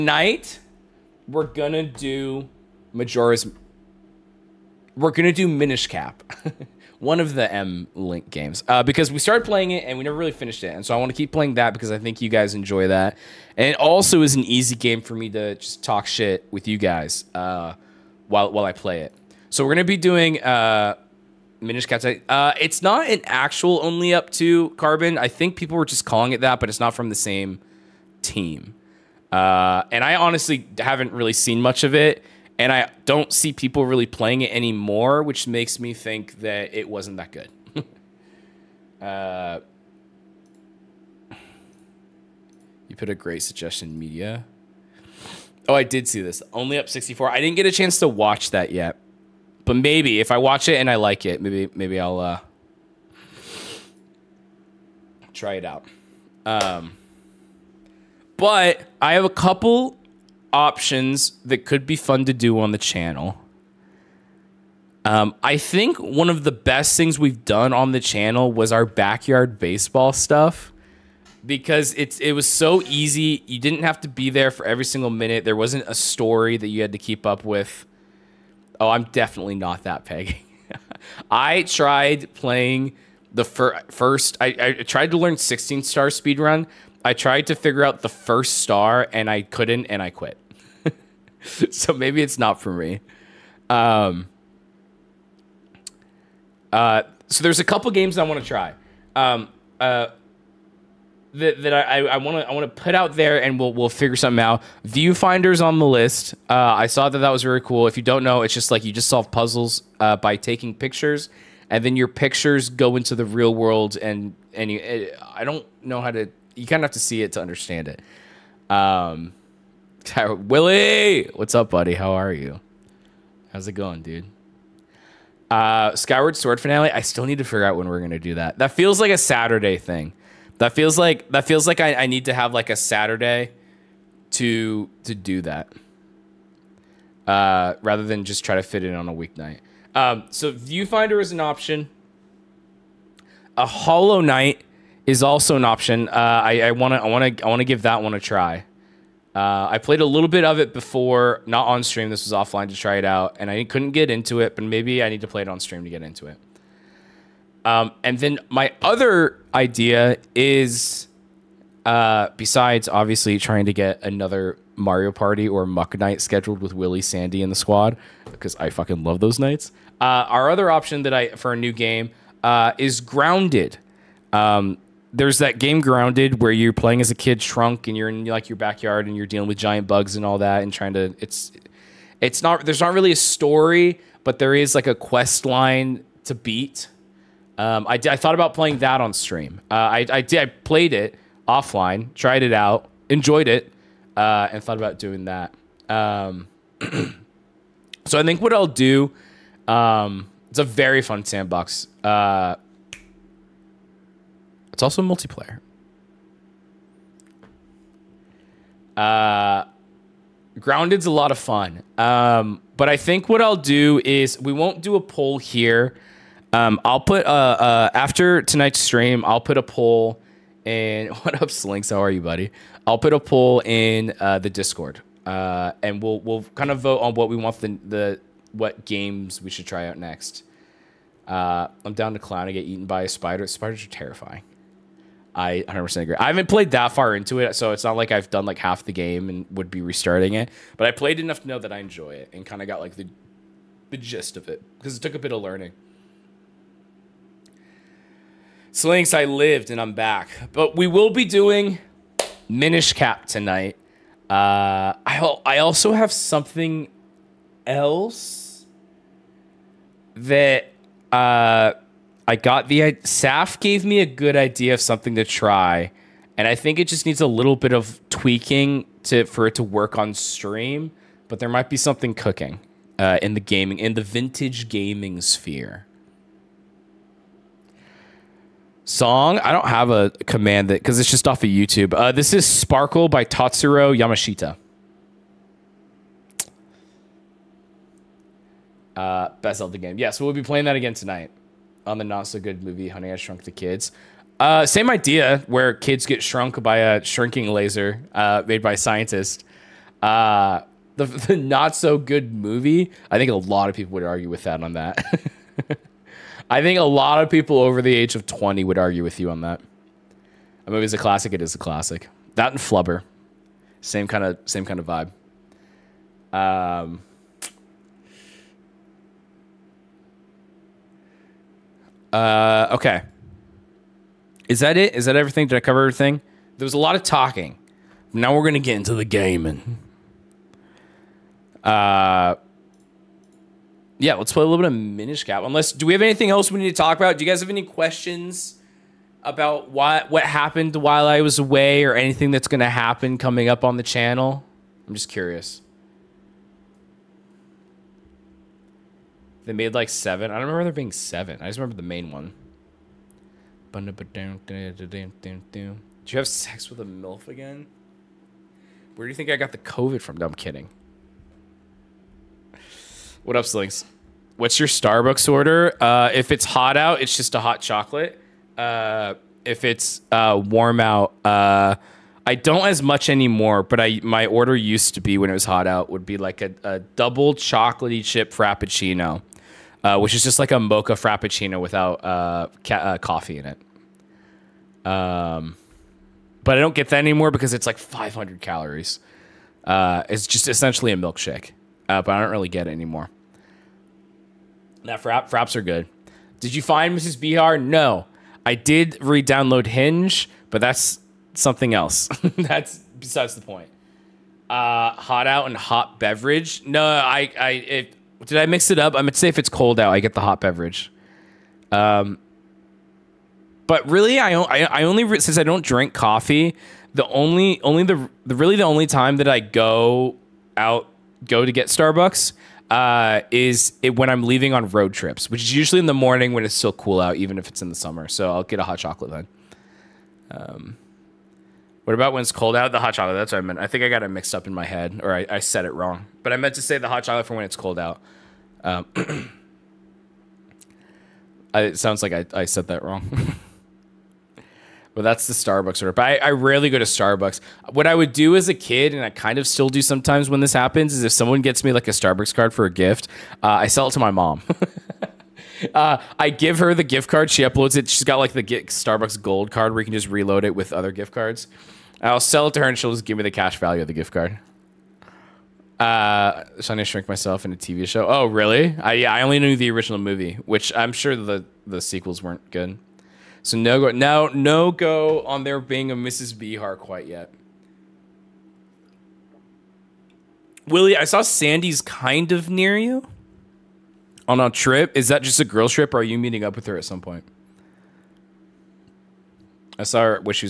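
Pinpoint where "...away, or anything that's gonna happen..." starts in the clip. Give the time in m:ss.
5:41.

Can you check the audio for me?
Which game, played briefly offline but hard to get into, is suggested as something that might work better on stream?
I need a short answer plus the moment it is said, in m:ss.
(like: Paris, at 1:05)
Hollow Knight, at 2:23.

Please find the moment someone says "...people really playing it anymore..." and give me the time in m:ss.
0:33.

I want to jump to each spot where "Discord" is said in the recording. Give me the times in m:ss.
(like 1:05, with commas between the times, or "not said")
3:44.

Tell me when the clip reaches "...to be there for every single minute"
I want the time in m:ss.
1:14.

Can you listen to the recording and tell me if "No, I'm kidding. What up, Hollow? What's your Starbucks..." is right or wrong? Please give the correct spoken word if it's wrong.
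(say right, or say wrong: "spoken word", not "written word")
wrong: "Slinks", not "Hollow".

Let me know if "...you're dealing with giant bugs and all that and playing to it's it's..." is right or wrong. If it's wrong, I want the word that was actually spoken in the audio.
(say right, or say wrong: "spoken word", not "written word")
wrong: "trying", not "playing".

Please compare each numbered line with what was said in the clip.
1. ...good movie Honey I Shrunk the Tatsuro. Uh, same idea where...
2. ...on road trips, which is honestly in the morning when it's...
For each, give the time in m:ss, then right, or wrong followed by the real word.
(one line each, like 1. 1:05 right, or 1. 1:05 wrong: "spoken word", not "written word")
1. 4:52 wrong: "Kids", not "Tatsuro"
2. 7:04 wrong: "usually", not "honestly".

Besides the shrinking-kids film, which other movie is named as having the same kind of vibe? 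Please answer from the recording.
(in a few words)
Flubber.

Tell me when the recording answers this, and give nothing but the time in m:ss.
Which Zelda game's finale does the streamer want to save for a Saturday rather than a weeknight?
2:05.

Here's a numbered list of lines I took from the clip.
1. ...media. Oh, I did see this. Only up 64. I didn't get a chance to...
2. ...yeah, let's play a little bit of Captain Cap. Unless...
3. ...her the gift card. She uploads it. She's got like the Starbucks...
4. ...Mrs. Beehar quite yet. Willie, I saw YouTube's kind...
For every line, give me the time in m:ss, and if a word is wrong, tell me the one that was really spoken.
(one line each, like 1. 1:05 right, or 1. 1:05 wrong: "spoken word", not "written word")
1. 0:43 right
2. 5:33 wrong: "Minish", not "Captain"
3. 7:36 right
4. 7:55 wrong: "Sandy", not "YouTube".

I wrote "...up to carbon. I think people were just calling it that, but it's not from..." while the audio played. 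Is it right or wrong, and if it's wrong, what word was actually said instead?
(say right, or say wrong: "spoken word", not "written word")
right.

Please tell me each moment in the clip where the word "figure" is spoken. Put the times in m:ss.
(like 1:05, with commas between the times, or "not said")
1:27, 1:43, 2:07.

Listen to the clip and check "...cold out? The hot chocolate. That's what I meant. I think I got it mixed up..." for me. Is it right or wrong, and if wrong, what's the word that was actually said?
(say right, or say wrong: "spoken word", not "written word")
right.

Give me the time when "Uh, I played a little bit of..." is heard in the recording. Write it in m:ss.
2:29.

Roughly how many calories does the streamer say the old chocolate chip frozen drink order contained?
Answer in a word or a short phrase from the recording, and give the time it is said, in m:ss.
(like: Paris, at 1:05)
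500, at 6:27.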